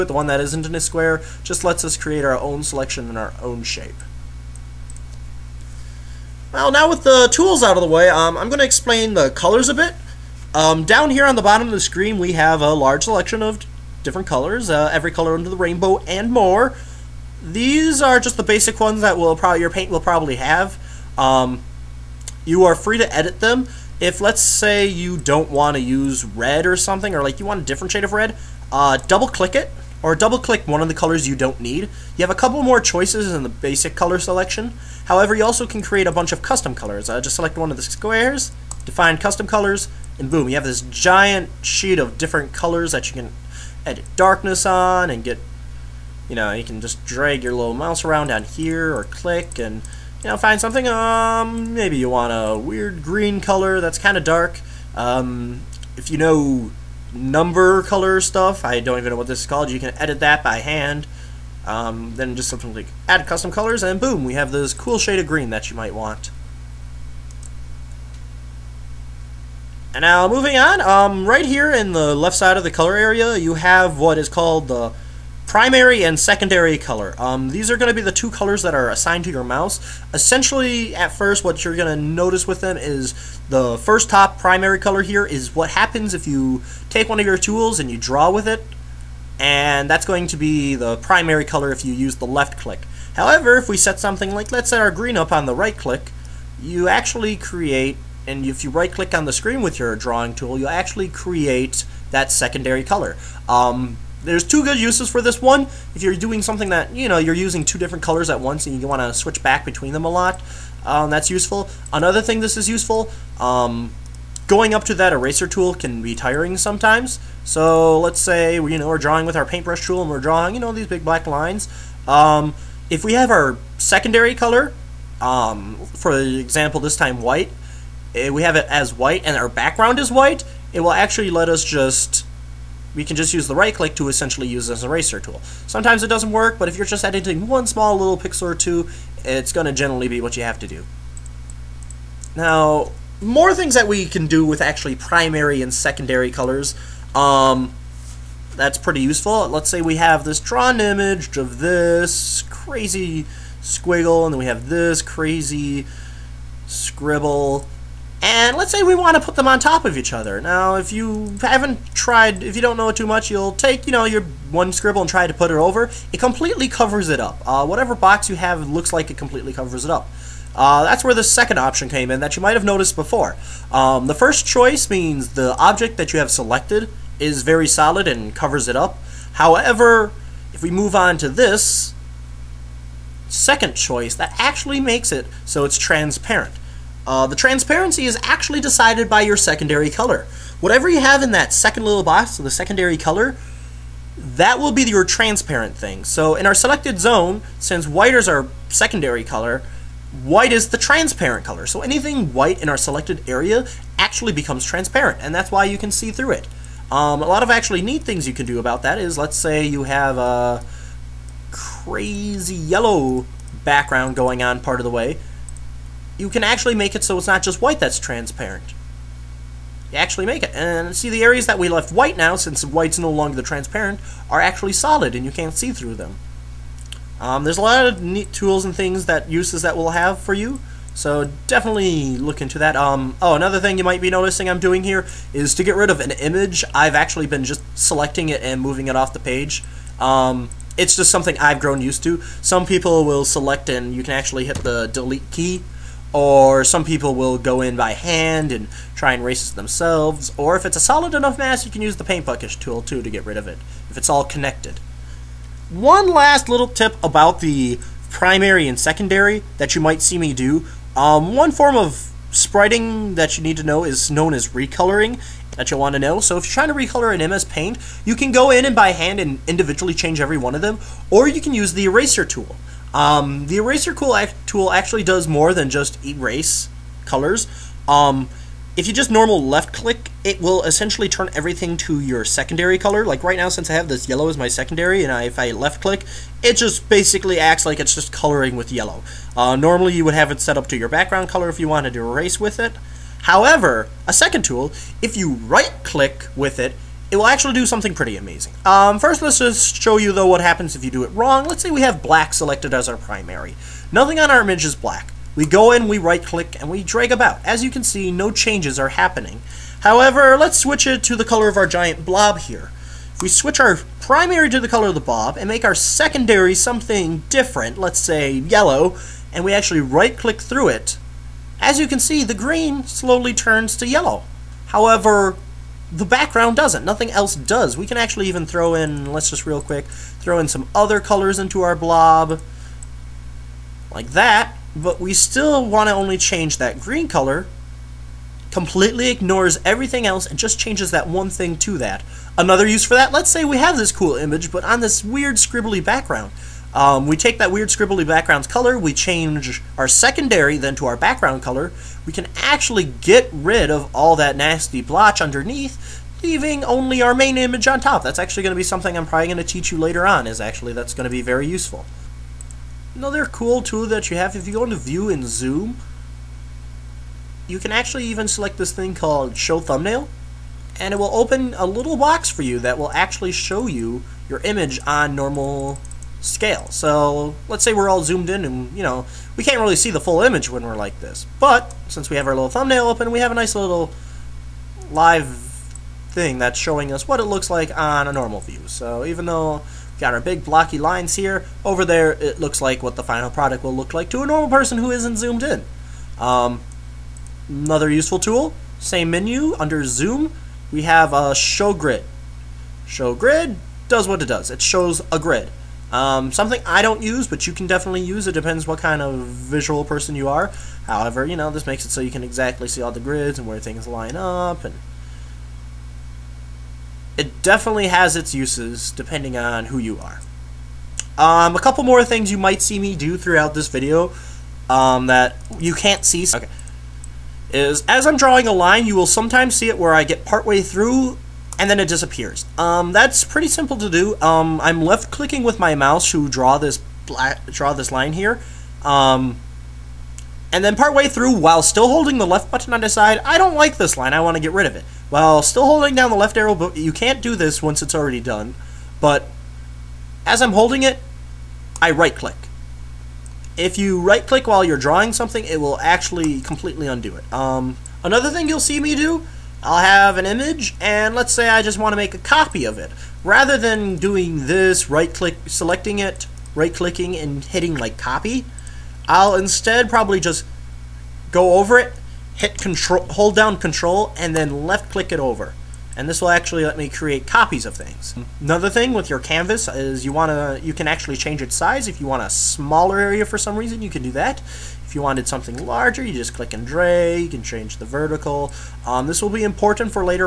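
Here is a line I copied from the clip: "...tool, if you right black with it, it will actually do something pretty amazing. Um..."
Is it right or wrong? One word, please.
wrong.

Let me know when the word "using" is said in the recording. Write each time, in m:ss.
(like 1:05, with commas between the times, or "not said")
1:47.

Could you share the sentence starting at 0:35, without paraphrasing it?
However, you also can create a bunch of custom colors.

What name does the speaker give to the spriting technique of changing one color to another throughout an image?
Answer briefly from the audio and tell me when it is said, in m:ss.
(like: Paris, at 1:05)
recoloring, at 4:24.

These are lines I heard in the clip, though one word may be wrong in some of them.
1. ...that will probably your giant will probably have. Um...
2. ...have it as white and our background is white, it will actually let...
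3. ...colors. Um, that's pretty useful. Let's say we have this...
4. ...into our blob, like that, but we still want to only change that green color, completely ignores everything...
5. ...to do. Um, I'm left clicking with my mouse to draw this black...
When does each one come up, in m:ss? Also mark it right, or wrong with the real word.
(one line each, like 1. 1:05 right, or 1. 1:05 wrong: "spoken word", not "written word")
1. 0:19 wrong: "paint", not "giant"
2. 2:08 right
3. 2:26 right
4. 5:31 right
5. 7:13 right.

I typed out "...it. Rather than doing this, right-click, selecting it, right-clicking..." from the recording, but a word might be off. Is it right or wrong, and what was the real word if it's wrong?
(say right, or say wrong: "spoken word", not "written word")
right.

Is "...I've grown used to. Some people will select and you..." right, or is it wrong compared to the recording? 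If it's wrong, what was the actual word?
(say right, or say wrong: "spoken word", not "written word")
right.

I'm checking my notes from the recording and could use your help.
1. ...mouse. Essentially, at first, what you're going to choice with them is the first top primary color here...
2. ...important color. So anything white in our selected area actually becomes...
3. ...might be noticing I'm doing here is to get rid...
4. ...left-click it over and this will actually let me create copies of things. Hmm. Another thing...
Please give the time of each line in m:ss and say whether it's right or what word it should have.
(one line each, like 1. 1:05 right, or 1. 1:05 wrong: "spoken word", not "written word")
1. 1:19 wrong: "notice", not "choice"
2. 3:20 wrong: "transparent", not "important"
3. 3:53 right
4. 7:54 right.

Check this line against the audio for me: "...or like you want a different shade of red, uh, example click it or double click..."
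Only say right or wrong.
wrong.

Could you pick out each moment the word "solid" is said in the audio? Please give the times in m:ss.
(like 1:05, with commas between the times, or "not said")
2:57, 3:44, 4:10.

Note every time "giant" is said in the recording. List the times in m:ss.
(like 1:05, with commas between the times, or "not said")
0:40, 5:11.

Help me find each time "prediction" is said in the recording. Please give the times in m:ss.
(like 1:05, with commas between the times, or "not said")
not said.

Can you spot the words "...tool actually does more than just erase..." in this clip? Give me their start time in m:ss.
4:33.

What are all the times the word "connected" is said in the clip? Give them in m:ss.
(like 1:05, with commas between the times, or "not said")
4:14.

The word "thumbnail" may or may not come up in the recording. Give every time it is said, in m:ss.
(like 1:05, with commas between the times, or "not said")
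6:09, 6:22.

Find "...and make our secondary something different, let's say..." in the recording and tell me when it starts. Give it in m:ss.
5:15.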